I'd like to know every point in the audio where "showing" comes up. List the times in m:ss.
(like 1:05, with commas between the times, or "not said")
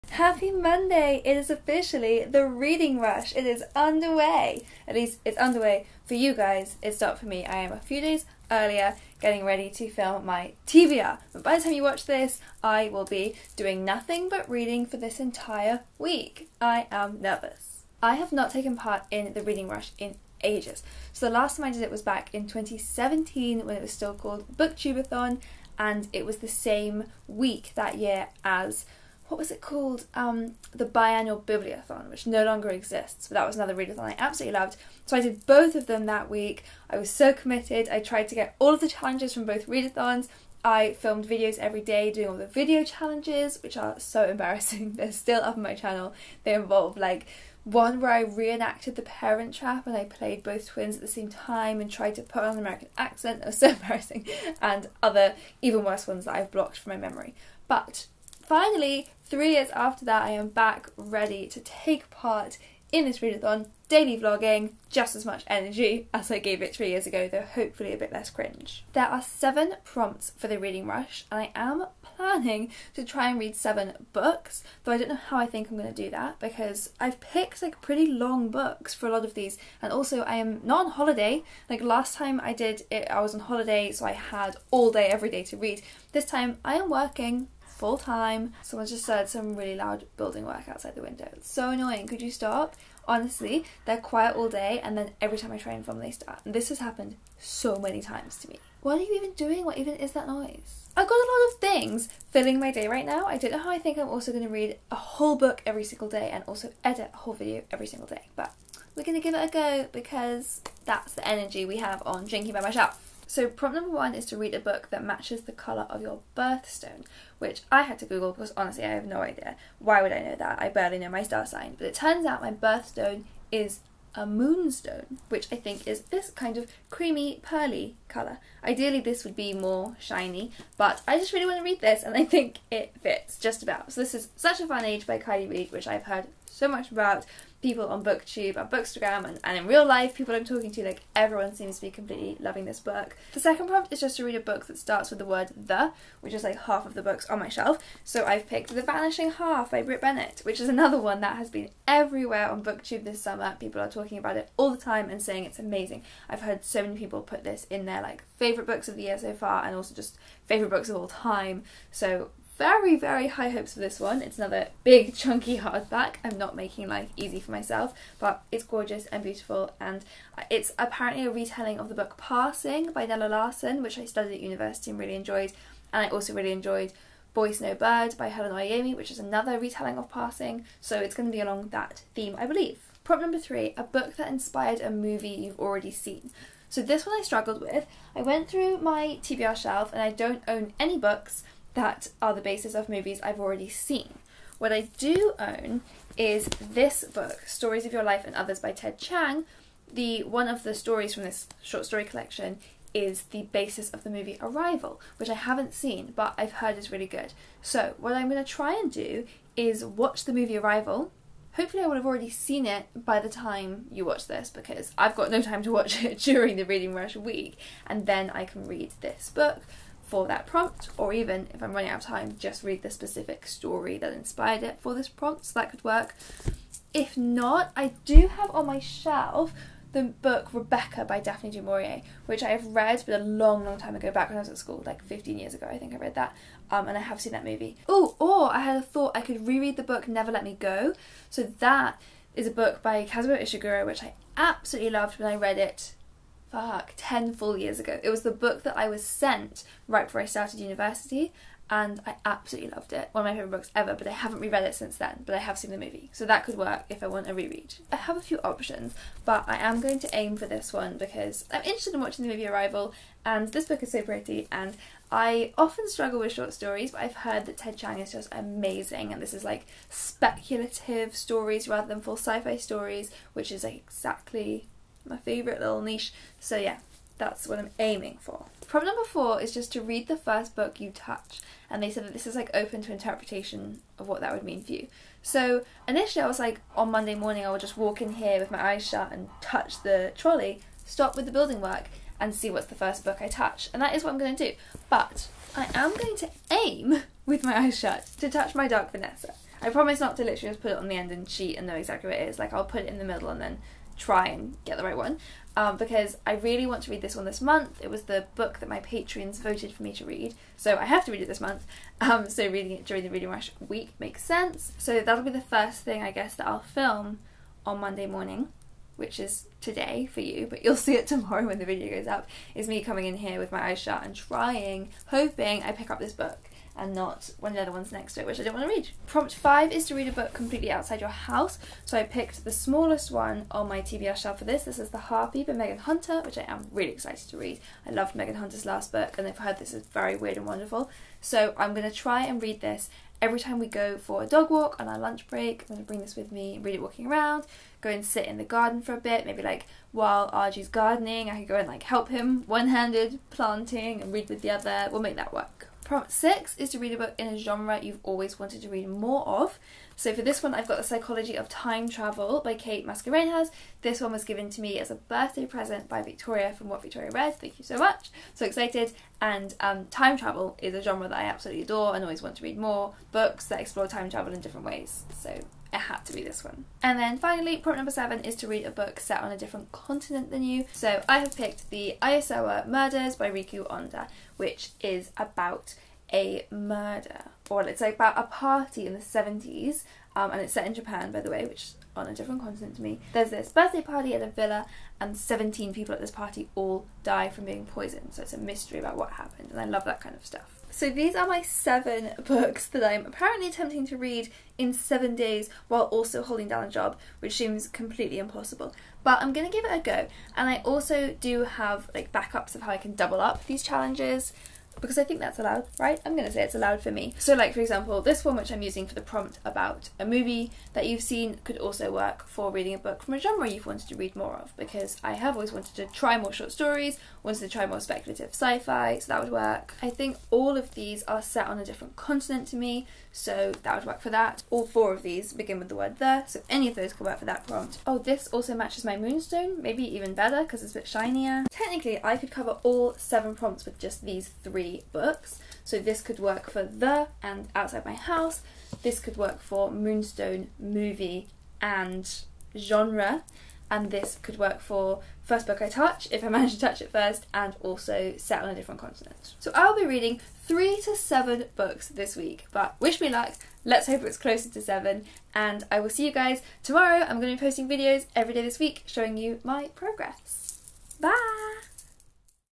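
7:48.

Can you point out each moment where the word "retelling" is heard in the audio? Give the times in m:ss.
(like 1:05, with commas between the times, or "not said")
2:51, 2:59.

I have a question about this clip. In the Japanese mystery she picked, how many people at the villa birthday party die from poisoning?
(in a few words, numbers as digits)
17.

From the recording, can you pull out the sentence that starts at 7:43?
Let's hope it's closer to seven.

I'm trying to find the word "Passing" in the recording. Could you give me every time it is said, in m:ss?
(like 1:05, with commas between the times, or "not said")
2:52, 3:00.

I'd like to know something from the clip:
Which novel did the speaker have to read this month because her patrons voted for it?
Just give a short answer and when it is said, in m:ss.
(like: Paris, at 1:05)
My Dark Vanessa, at 4:58.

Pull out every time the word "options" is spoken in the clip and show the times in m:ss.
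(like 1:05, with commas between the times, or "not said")
4:18.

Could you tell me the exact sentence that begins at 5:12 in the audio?
Um, so reading it during the Reading Rush week makes sense.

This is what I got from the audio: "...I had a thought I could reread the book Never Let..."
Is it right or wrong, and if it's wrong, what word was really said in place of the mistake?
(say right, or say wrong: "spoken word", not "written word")
right.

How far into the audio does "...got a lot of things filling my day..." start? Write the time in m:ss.
1:41.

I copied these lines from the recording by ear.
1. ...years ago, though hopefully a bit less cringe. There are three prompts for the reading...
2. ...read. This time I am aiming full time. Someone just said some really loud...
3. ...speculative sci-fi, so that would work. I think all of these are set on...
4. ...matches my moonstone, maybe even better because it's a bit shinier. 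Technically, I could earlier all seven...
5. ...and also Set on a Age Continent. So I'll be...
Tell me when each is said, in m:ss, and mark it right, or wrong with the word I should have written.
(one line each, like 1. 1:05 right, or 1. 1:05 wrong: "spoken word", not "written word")
1. 1:06 wrong: "seven", not "three"
2. 1:25 wrong: "working", not "aiming"
3. 7:07 right
4. 7:18 wrong: "cover", not "earlier"
5. 7:37 wrong: "Different", not "Age".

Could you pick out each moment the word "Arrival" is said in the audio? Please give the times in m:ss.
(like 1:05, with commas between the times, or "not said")
3:24, 3:30, 4:22.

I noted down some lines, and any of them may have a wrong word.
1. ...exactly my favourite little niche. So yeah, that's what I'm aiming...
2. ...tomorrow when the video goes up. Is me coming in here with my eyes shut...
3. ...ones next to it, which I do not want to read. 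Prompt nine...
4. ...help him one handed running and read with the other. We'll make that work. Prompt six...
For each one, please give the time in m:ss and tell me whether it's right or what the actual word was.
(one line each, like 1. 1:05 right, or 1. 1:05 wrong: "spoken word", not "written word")
1. 4:33 right
2. 5:21 right
3. 5:27 wrong: "five", not "nine"
4. 5:51 wrong: "planting", not "running".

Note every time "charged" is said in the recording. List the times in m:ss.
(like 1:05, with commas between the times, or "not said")
not said.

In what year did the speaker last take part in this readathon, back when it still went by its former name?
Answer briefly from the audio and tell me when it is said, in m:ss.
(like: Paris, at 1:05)
2017, at 0:22.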